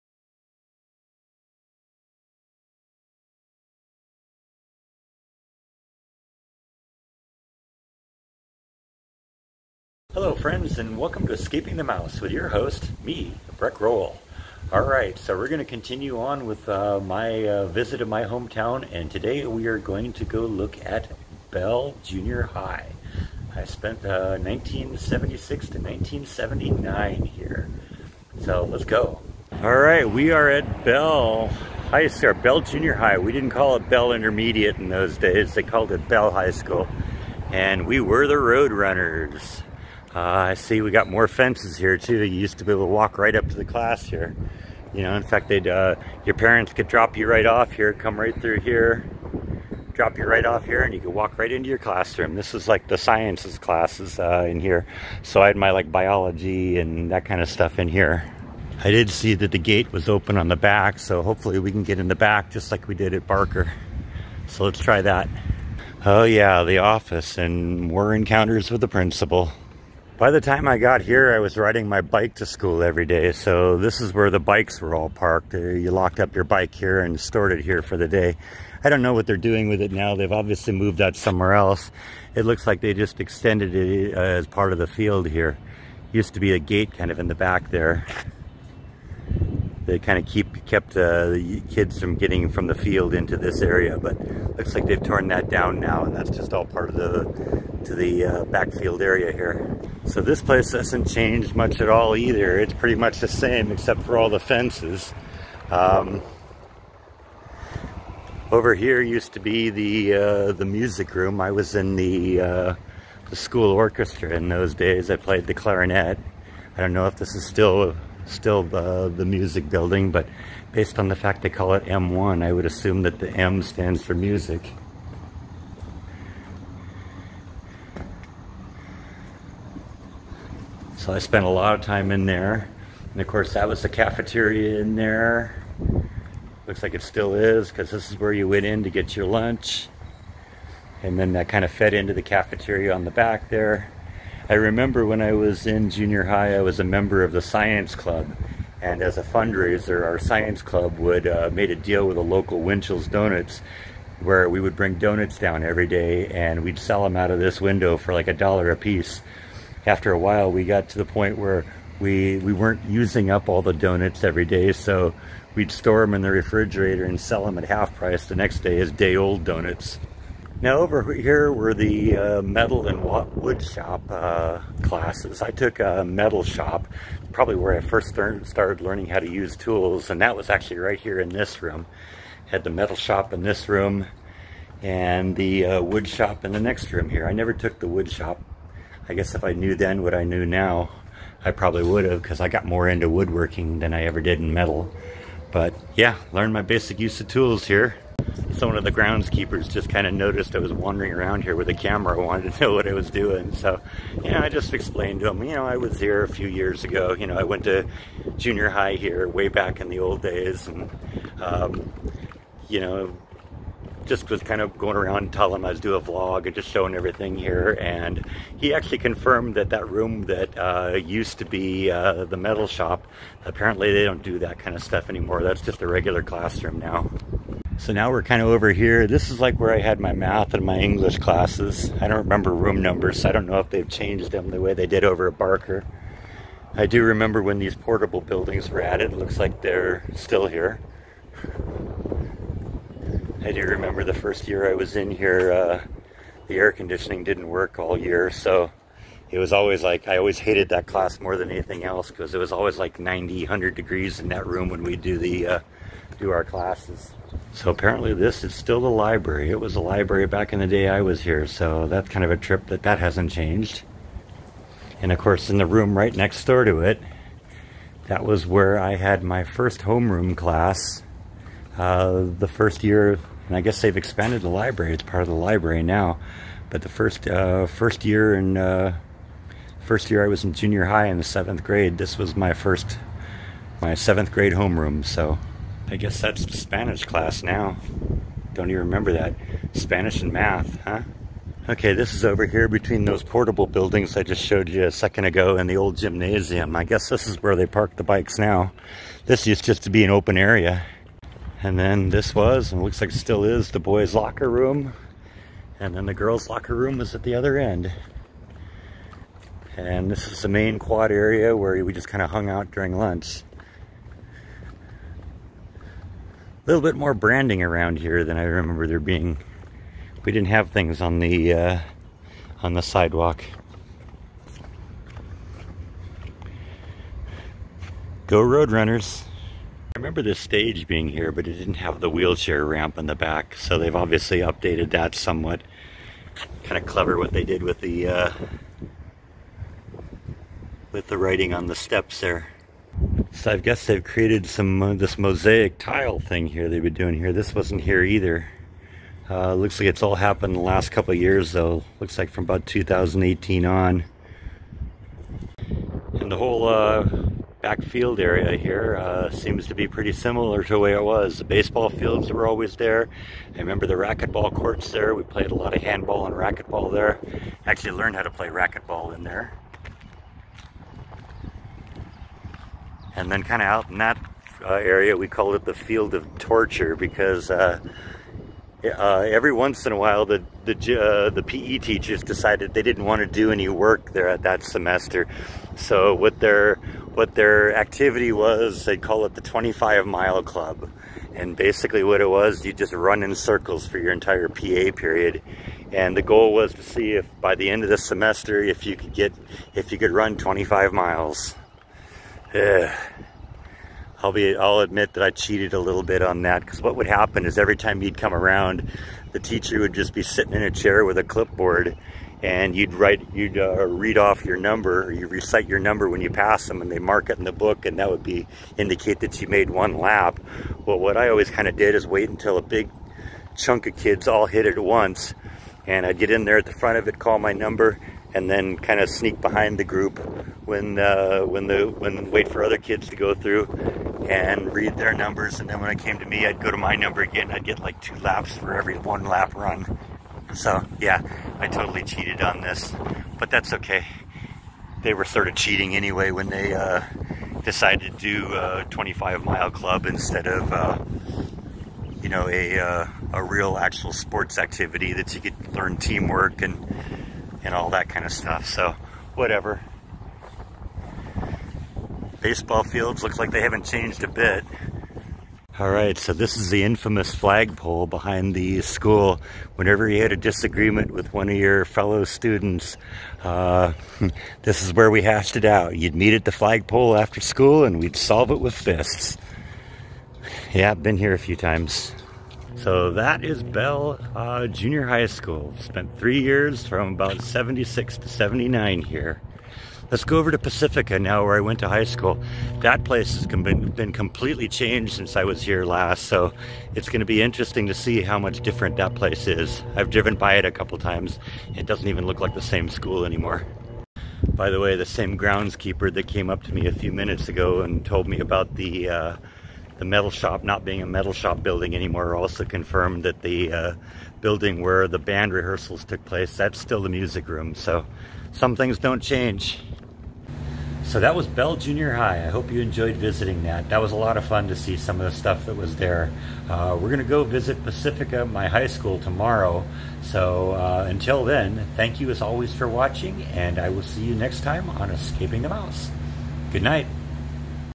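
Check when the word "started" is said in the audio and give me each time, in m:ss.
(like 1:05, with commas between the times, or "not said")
2:58.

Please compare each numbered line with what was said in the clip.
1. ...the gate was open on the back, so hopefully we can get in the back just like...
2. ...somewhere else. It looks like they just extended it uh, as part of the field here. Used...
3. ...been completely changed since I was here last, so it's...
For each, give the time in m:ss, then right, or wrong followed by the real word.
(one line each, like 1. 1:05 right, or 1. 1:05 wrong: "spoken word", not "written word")
1. 0:59 right
2. 1:21 right
3. 8:13 right.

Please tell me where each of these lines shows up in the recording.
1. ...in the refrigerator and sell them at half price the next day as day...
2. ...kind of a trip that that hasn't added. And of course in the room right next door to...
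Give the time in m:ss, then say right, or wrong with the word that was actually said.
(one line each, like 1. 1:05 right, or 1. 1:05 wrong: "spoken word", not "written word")
1. 2:46 right
2. 4:22 wrong: "changed", not "added".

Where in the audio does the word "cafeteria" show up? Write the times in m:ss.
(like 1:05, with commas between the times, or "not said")
2:13, 2:22.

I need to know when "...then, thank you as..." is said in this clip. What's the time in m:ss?
8:51.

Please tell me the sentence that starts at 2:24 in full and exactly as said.
I remember when I was in junior high, I was a member of the science club.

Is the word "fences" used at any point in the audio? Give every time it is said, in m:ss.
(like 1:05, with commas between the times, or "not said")
0:41, 1:44.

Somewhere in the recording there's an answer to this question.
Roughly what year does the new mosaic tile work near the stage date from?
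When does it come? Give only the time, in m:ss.
5:52.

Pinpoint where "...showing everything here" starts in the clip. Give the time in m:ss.
3:36.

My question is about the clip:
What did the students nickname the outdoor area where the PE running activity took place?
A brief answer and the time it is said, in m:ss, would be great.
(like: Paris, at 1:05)
field of torture, at 6:15.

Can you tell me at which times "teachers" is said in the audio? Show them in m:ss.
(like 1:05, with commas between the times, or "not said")
6:21, 6:49.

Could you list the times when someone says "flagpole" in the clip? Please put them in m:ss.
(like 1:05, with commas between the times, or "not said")
7:47, 7:56.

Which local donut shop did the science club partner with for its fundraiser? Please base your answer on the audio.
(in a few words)
Winchell's Donuts.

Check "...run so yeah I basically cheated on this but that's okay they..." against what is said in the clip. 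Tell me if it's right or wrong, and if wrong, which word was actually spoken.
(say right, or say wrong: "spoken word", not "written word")
wrong: "totally", not "basically".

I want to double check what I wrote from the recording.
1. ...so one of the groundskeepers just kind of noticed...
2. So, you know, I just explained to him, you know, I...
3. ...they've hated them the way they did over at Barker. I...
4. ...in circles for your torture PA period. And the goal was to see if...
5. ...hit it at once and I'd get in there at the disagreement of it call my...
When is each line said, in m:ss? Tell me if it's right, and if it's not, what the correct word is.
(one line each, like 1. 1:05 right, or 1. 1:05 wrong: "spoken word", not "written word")
1. 3:18 right
2. 3:23 right
3. 3:53 wrong: "changed", not "hated"
4. 6:33 wrong: "entire", not "torture"
5. 7:04 wrong: "front", not "disagreement".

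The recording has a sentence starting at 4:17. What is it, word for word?
So apparently this is still the library.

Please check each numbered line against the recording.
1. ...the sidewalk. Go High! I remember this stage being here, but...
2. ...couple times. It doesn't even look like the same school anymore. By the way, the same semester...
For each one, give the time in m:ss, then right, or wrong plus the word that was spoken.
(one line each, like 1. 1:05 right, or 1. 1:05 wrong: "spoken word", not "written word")
1. 5:22 wrong: "Roadrunners", not "High"
2. 8:20 wrong: "groundskeeper", not "semester".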